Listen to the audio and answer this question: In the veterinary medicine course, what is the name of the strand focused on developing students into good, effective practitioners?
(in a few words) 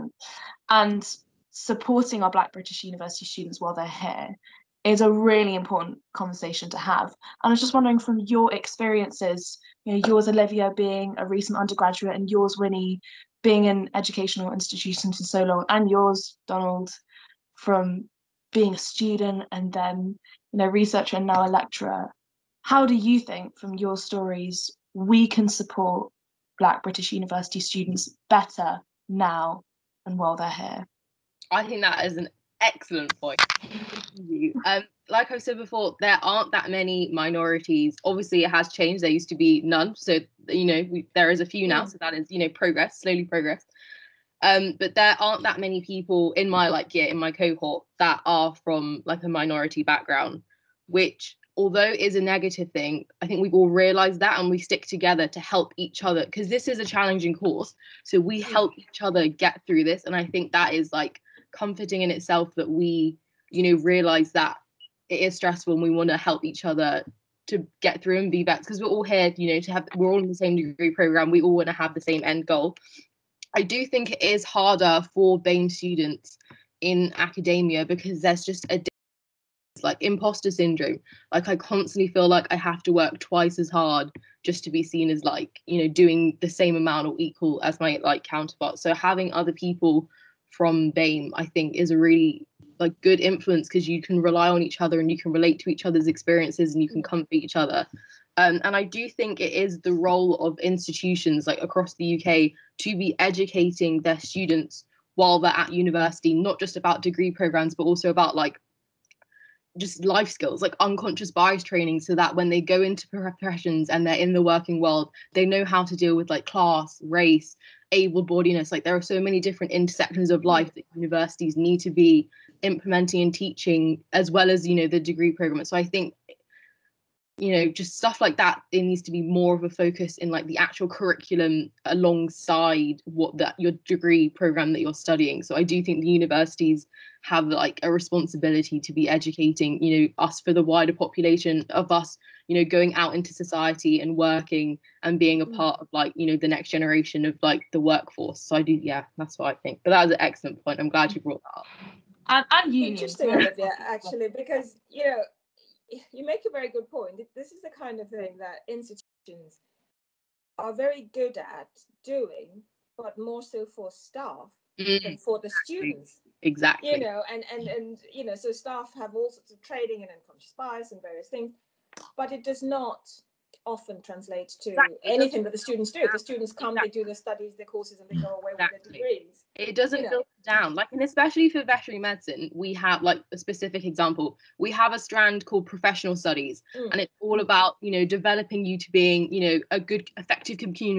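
Professional studies.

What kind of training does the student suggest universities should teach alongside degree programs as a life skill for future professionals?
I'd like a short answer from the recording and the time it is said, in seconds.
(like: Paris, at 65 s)
Unconscious bias training, at 110 s.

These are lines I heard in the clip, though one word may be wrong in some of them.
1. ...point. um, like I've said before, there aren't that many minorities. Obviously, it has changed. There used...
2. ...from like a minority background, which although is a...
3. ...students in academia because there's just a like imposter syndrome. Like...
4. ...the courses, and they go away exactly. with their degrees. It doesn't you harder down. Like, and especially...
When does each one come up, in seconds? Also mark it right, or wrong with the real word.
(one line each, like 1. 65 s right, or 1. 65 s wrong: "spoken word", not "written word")
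1. 33 s right
2. 48 s right
3. 75 s right
4. 177 s wrong: "filter", not "harder".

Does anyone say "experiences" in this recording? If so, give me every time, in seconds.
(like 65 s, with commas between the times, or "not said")
8 s, 96 s.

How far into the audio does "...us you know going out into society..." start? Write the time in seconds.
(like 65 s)
141 s.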